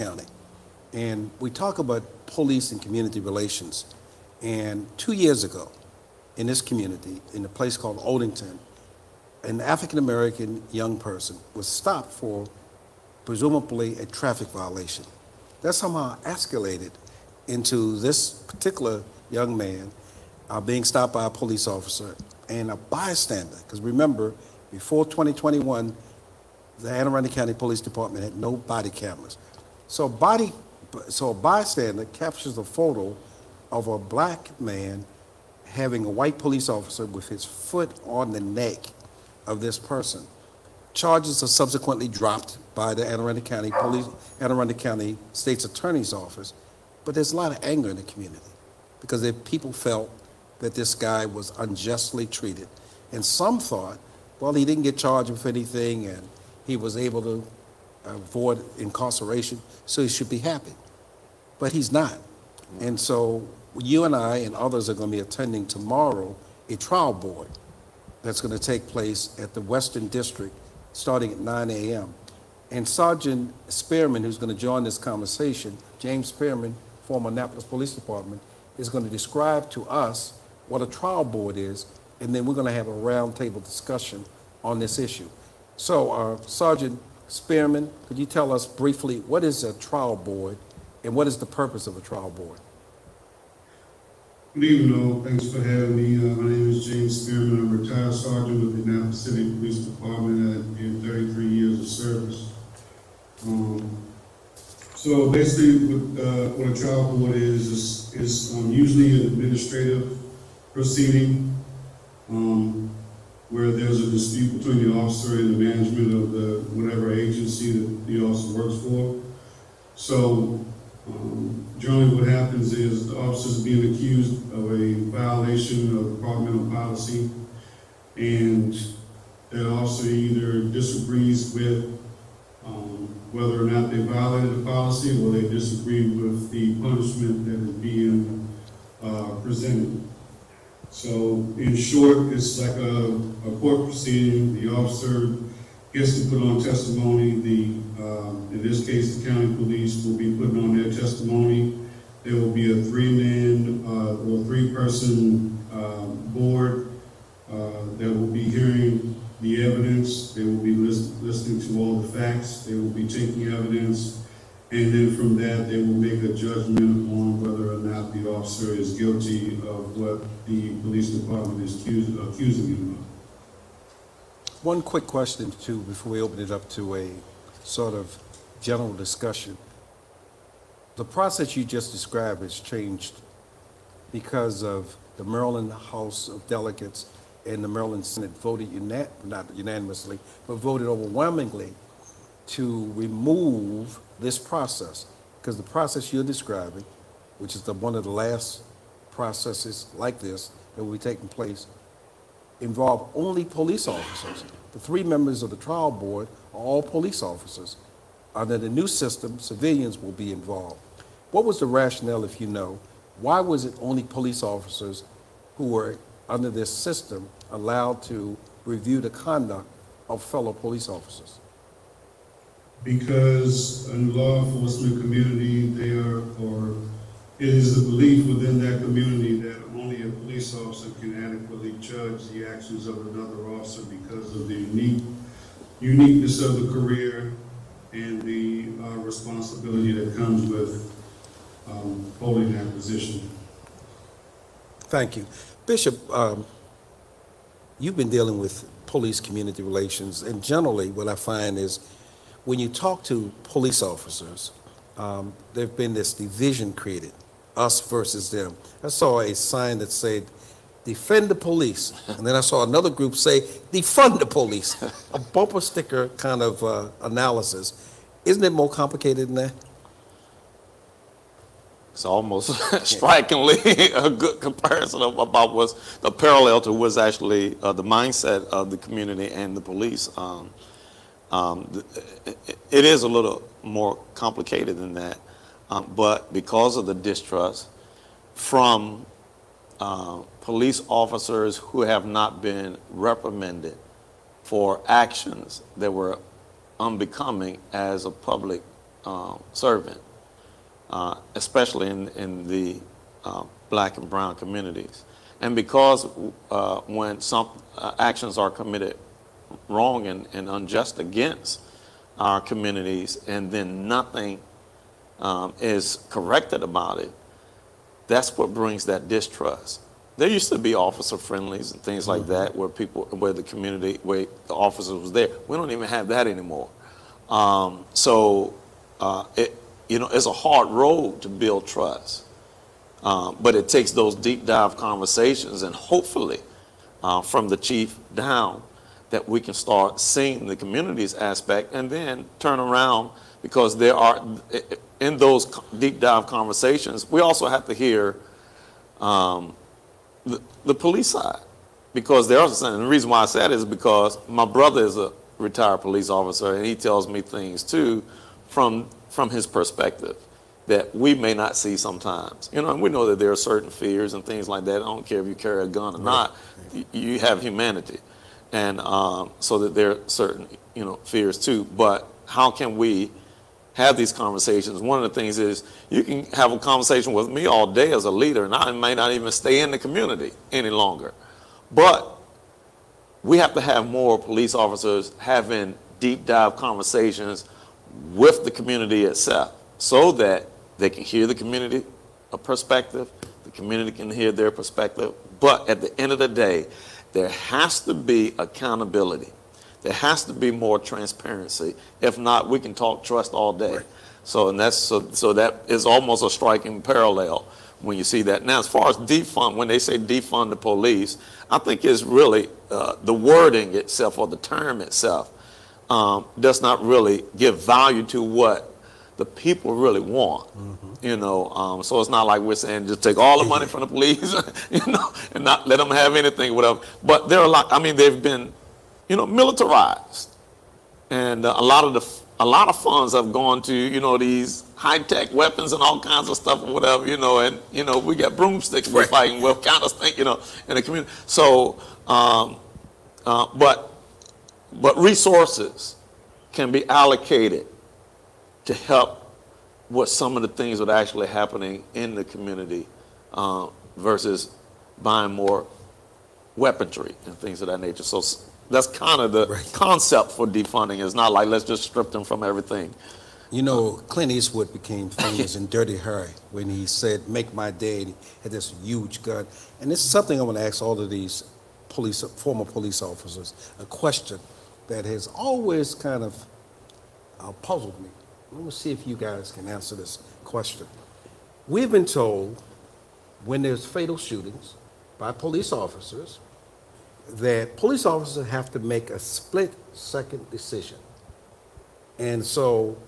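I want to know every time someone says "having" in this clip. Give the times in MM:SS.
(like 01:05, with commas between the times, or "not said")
00:35, 01:35, 06:25.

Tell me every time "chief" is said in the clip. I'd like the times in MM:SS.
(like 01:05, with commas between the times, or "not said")
05:37.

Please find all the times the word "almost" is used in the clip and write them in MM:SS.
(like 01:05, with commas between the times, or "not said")
04:32, 06:45.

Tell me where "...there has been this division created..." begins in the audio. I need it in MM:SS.
04:15.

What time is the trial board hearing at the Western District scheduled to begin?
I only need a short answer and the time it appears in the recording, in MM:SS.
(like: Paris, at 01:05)
9 a.m., at 01:11.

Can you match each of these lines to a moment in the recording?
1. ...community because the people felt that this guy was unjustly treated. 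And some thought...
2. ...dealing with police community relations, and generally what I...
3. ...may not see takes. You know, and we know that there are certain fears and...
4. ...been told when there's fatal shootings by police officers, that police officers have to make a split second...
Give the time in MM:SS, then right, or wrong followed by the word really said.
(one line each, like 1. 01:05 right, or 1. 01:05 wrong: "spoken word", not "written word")
1. 00:48 right
2. 04:08 right
3. 06:01 wrong: "sometimes", not "takes"
4. 08:01 right.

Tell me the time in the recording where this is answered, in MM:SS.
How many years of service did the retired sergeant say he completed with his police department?
01:41.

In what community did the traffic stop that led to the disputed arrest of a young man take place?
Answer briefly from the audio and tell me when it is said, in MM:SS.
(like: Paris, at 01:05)
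Odenton, at 00:07.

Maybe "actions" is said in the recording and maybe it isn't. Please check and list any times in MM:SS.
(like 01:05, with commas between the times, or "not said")
03:52, 04:54, 05:07.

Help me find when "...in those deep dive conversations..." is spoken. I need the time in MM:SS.
05:44.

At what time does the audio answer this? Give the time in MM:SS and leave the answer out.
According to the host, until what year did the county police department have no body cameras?
00:25.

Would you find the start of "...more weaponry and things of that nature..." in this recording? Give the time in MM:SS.
07:35.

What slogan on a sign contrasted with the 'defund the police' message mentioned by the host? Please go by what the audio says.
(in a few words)
Defend the police.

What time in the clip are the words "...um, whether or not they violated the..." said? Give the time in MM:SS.
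02:12.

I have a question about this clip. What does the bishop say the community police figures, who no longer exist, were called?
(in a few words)
Officer Friendlies.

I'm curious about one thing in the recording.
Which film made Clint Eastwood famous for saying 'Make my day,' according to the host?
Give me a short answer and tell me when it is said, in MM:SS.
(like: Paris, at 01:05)
Dirty Harry, at 07:45.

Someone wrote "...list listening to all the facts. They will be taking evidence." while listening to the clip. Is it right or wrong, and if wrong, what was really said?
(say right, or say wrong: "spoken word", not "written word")
right.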